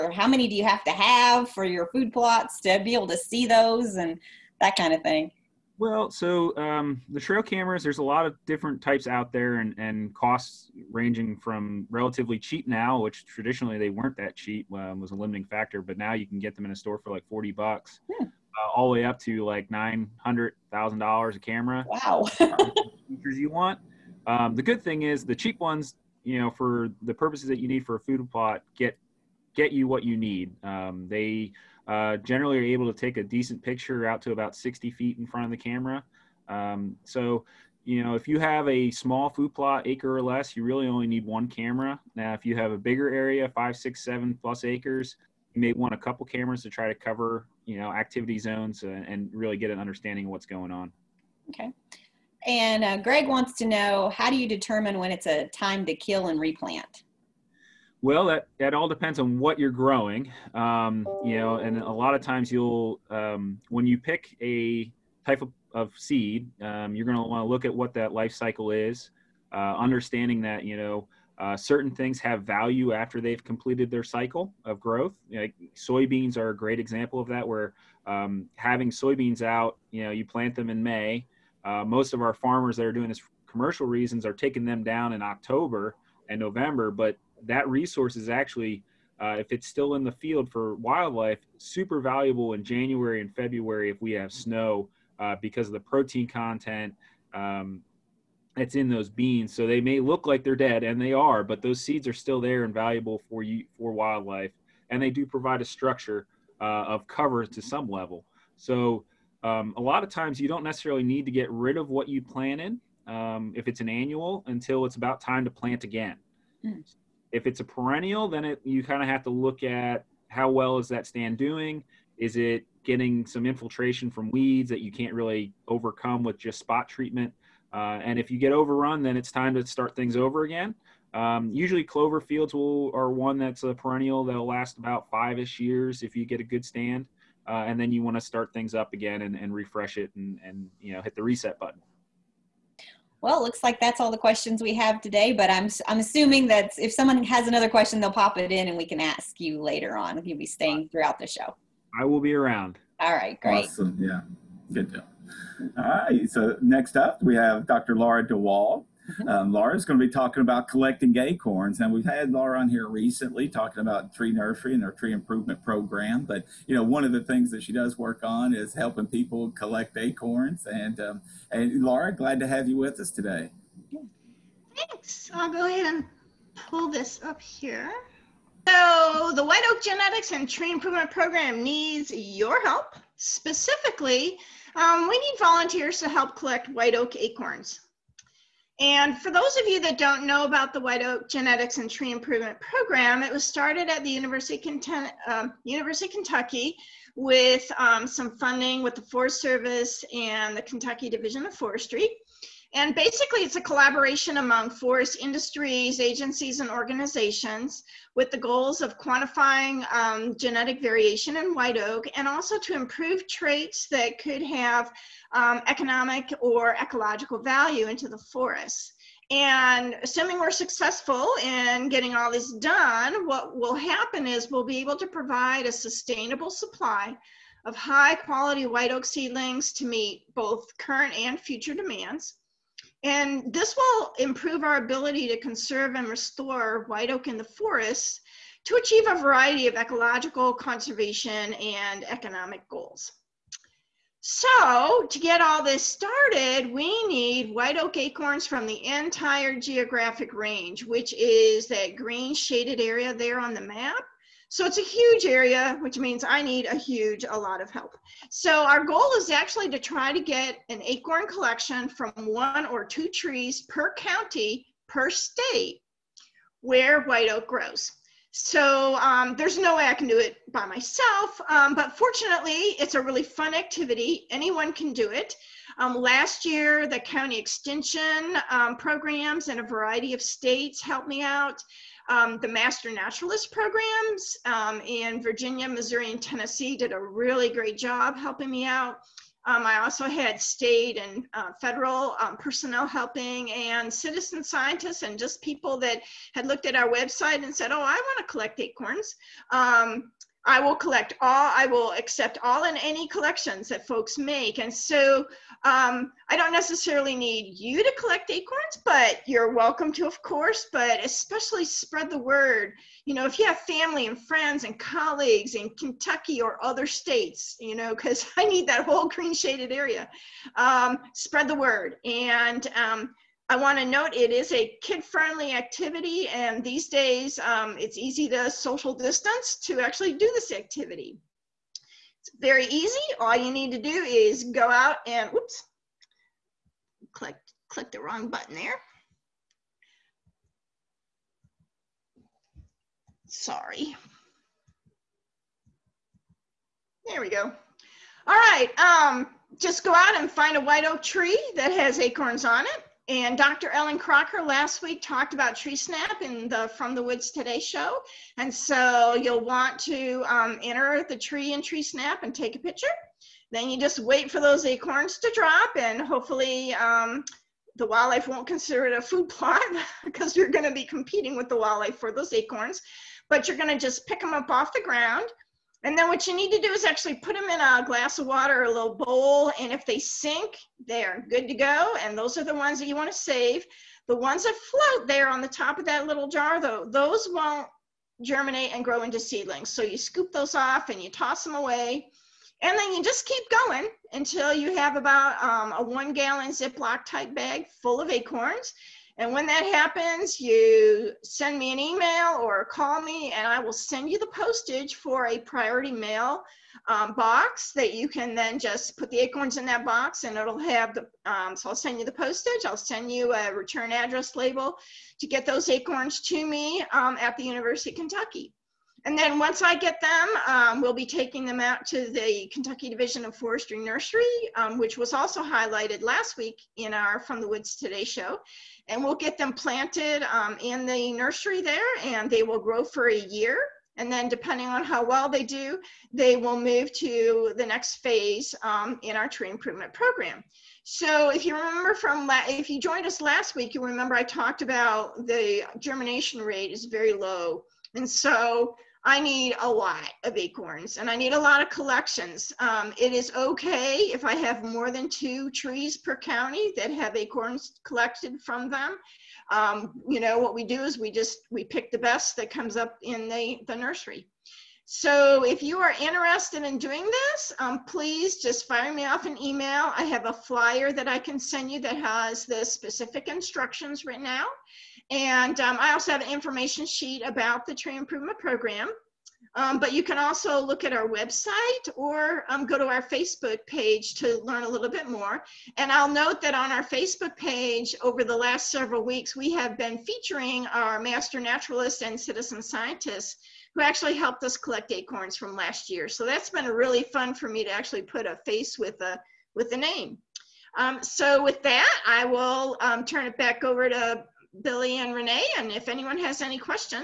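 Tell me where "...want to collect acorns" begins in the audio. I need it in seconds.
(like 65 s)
297 s.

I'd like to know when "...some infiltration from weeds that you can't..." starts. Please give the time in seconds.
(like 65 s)
123 s.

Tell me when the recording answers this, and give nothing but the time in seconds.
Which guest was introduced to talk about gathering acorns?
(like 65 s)
157 s.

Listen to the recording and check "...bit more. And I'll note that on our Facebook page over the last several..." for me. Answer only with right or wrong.
right.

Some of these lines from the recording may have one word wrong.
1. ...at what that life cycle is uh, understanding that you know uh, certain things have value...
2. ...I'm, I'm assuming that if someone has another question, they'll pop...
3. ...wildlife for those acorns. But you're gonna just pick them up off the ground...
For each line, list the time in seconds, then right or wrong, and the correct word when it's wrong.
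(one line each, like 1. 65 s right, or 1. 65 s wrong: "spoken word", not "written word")
1. 67 s right
2. 145 s right
3. 371 s right.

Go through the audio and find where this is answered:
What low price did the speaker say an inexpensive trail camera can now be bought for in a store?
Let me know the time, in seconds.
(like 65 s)
17 s.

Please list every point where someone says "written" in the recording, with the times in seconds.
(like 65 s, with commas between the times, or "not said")
474 s.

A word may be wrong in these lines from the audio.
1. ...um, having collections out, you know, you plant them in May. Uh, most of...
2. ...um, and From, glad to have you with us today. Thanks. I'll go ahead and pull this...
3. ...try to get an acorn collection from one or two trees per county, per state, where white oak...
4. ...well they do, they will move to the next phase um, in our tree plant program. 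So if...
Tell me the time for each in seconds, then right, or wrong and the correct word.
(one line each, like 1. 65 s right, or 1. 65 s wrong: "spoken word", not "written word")
1. 78 s wrong: "soybeans", not "collections"
2. 171 s wrong: "Laura", not "From"
3. 259 s right
4. 435 s wrong: "improvement", not "plant".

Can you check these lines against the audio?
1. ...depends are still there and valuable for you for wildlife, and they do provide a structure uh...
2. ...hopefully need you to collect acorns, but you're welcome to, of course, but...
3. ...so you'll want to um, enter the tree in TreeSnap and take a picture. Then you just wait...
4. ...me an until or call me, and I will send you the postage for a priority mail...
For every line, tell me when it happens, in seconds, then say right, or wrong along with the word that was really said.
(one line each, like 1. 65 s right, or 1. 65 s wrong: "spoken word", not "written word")
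1. 101 s wrong: "seeds", not "depends"
2. 306 s wrong: "necessarily", not "hopefully"
3. 358 s right
4. 401 s wrong: "email", not "until".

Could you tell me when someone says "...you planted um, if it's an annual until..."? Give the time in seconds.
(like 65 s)
112 s.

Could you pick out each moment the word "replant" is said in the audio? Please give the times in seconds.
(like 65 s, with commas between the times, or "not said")
56 s.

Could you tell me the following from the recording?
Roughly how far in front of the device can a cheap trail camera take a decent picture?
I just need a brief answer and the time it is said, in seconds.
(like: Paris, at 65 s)
60 feet, at 34 s.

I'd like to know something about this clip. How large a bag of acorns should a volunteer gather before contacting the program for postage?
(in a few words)
1 gallon.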